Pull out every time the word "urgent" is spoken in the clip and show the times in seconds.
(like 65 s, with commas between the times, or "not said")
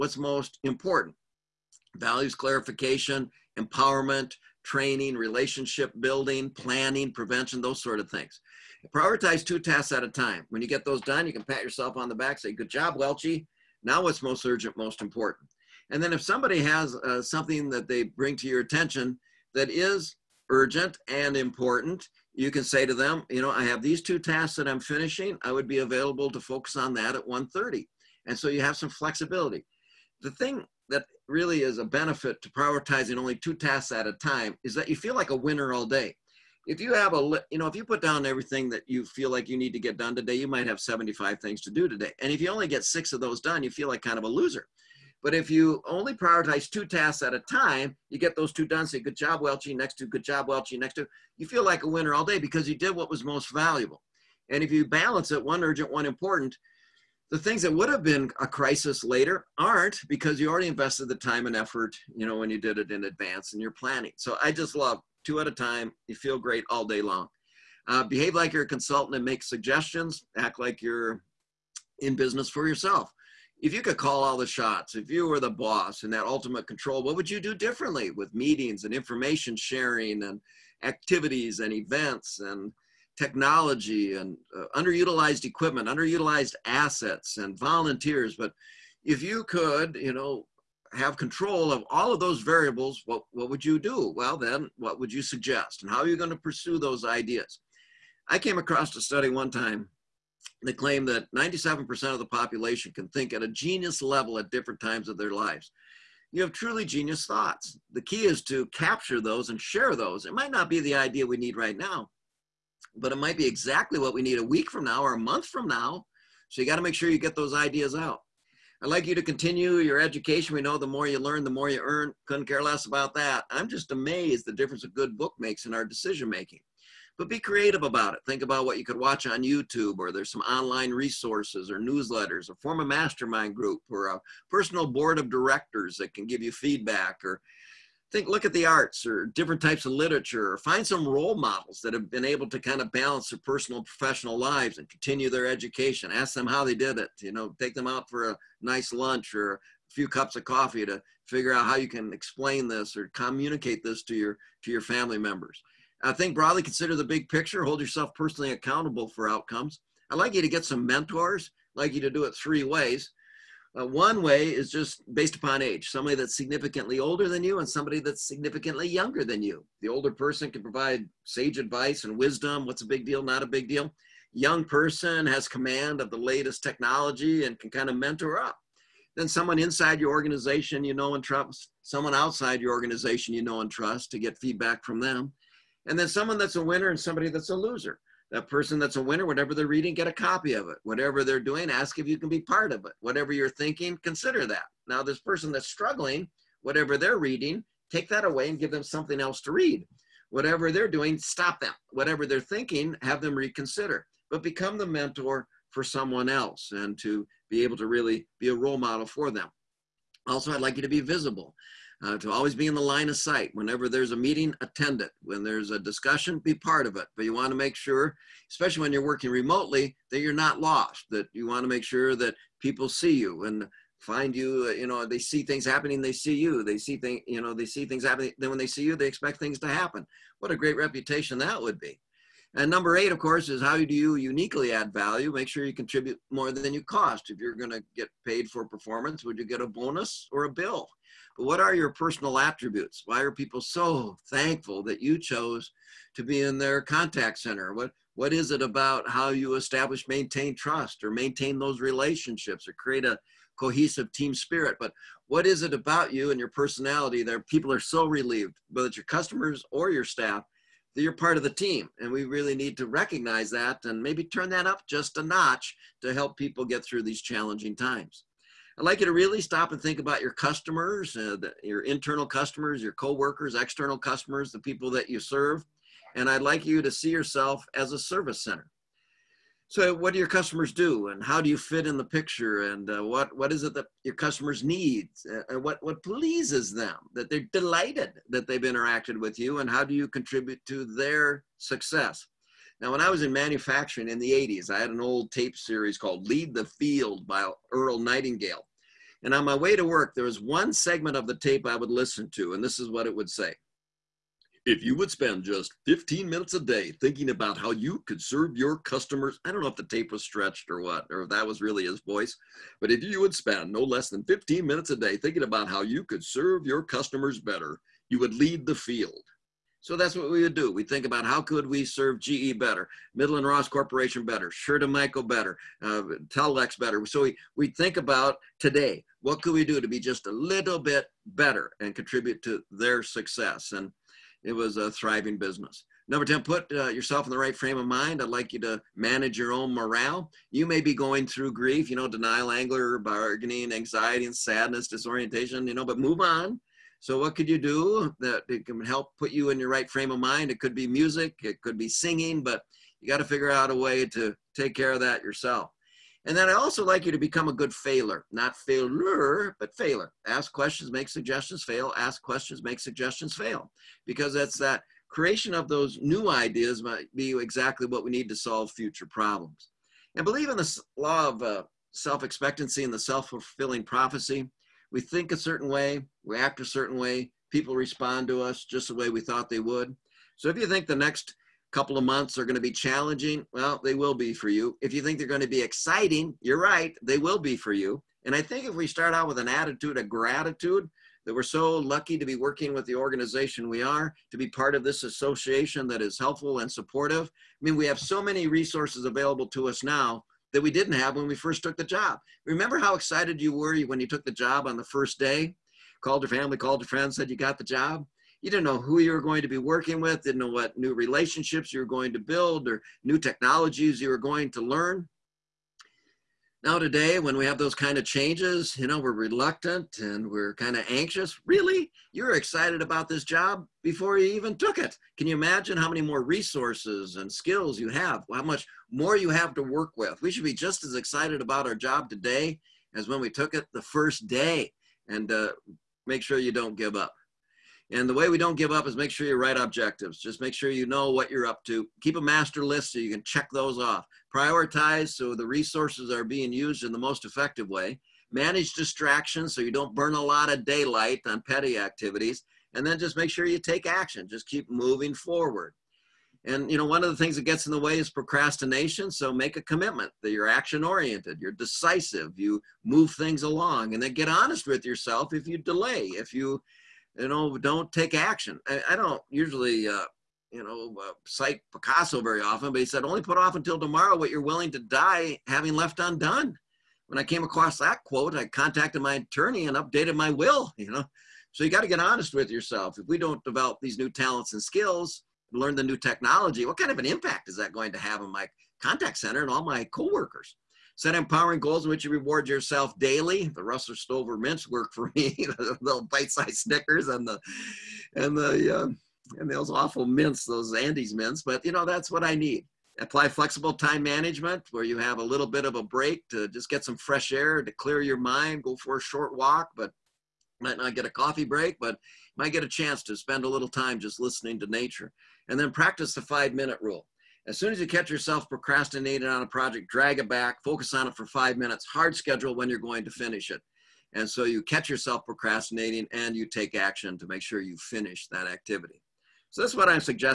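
14 s, 20 s, 55 s.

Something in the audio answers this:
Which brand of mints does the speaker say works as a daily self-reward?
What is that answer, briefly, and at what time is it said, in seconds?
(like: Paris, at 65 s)
Russell Stover, at 493 s.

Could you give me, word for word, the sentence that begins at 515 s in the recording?
And then practice the five minute rule.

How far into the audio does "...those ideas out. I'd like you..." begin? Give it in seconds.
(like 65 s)
117 s.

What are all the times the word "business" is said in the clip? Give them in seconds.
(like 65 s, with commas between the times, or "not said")
72 s, 335 s.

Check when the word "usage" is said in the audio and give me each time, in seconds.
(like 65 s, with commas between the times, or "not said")
not said.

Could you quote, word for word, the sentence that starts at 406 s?
Called your family, called your friends, said you got the job.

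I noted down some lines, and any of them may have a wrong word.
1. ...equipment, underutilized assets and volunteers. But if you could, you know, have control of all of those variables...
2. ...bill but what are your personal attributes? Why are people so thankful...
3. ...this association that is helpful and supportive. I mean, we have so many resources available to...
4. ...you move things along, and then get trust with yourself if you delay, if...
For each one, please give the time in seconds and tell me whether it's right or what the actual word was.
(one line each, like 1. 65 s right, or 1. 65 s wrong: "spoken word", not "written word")
1. 85 s right
2. 240 s right
3. 394 s right
4. 462 s wrong: "honest", not "trust".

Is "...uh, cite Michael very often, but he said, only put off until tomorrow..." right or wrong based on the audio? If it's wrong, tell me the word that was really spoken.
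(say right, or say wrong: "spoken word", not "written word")
wrong: "Picasso", not "Michael".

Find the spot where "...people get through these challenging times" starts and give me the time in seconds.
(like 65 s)
266 s.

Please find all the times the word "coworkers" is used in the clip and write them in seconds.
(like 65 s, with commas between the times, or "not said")
272 s, 489 s.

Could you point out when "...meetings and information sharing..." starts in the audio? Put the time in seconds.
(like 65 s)
78 s.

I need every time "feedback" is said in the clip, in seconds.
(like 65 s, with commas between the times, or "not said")
136 s, 184 s.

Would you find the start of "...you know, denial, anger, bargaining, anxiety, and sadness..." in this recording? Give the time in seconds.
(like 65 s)
341 s.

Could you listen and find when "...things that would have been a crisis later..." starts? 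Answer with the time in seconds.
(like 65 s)
57 s.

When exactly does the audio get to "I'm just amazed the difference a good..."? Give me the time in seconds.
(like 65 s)
123 s.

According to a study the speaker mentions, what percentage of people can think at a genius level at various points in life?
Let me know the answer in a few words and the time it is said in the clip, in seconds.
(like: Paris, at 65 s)
97%, at 101 s.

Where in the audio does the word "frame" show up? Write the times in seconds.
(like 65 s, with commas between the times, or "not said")
337 s, 349 s.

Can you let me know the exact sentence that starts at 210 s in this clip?
Also, I'd like you to be visible uh, to always be in the line of sight.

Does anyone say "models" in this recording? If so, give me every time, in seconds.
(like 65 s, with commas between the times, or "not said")
141 s, 208 s.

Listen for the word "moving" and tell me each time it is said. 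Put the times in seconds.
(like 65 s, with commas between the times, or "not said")
454 s.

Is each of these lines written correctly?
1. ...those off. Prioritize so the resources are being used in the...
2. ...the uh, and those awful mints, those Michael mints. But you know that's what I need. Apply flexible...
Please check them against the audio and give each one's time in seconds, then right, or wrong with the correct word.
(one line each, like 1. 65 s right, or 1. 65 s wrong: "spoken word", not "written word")
1. 443 s right
2. 498 s wrong: "Andes", not "Michael".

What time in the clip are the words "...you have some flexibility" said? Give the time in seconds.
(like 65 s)
28 s.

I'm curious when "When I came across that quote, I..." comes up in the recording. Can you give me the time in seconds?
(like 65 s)
477 s.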